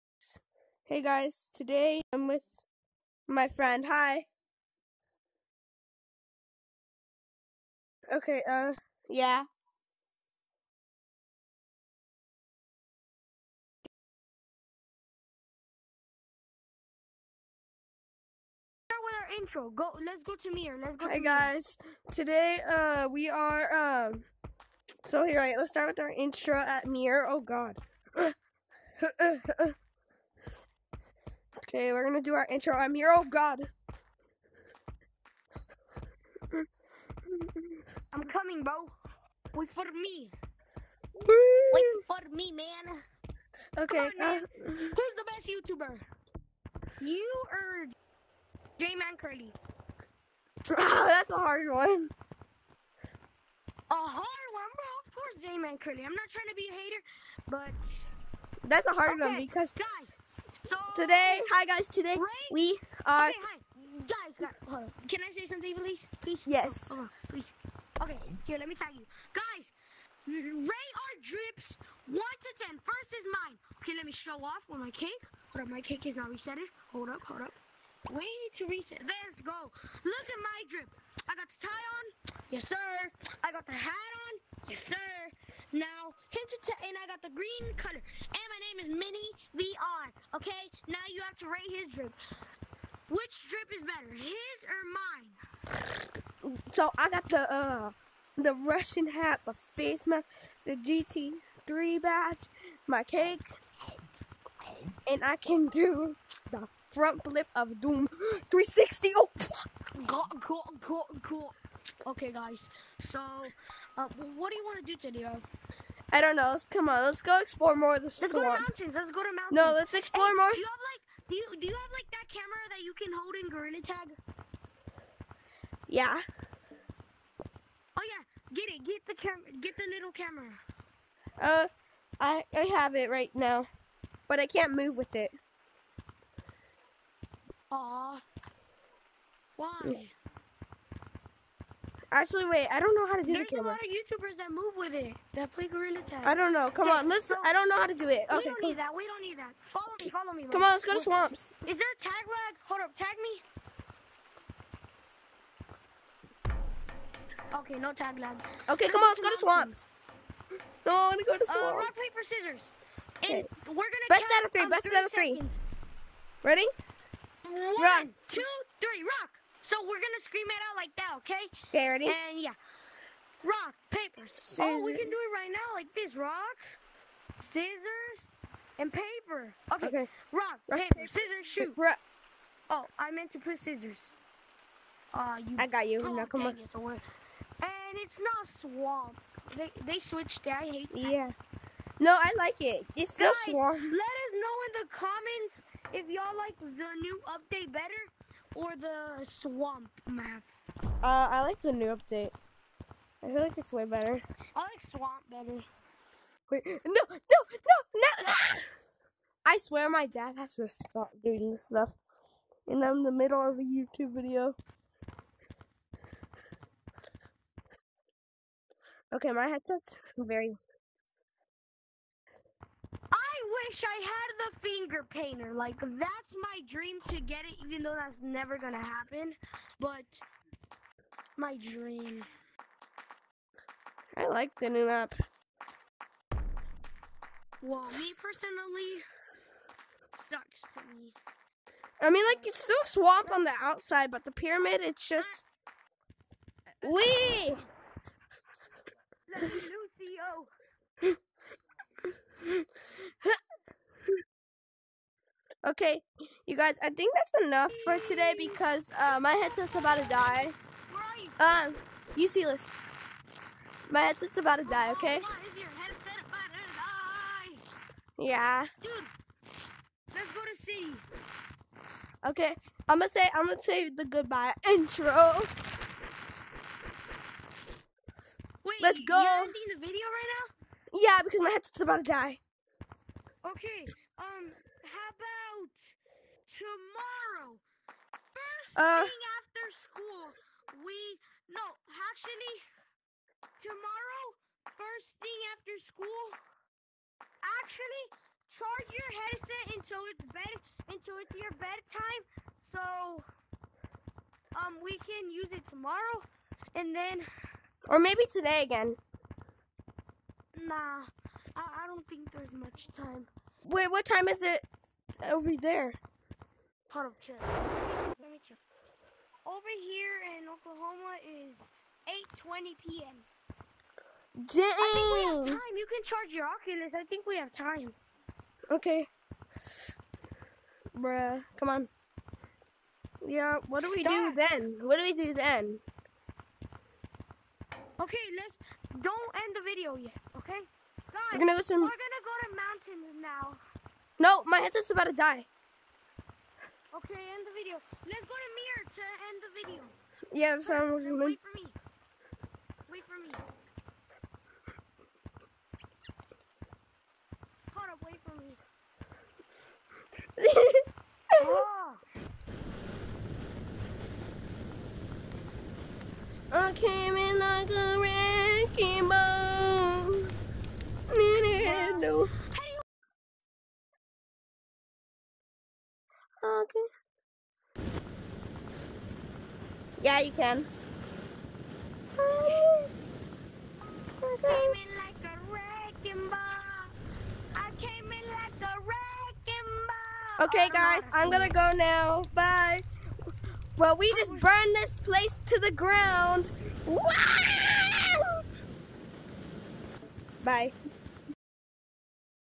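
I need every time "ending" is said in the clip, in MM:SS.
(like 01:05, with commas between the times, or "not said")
04:39.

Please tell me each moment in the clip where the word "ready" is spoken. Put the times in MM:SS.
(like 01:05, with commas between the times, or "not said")
02:46, 02:51.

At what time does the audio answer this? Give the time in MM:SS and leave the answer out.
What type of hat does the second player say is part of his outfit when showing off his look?
01:38.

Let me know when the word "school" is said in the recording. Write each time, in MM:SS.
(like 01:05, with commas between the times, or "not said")
04:49, 04:55.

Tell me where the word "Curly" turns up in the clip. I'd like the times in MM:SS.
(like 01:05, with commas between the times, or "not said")
00:49, 00:55.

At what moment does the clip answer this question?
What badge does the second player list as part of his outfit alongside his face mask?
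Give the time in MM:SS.
01:40.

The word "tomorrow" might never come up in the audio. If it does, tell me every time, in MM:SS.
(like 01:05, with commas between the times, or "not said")
04:46, 04:53, 05:05.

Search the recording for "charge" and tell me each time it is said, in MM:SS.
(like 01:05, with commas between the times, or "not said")
04:58, 05:26.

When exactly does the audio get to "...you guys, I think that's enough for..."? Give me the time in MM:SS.
04:16.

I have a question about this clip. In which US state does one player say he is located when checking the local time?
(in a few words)
Oklahoma.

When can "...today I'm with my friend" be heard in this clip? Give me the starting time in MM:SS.
00:01.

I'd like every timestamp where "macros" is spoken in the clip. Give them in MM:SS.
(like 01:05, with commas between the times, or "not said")
not said.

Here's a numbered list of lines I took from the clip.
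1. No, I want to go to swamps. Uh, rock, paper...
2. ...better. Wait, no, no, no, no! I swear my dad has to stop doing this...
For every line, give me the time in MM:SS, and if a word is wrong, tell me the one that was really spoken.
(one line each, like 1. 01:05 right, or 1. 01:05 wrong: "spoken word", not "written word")
1. 02:40 right
2. 03:25 right.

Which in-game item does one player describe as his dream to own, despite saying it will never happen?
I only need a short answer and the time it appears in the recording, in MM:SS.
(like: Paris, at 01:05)
finger painter, at 03:44.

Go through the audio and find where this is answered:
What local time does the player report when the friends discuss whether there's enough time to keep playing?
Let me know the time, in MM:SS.
05:22.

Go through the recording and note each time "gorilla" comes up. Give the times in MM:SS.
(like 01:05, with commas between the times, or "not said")
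02:03, 02:25.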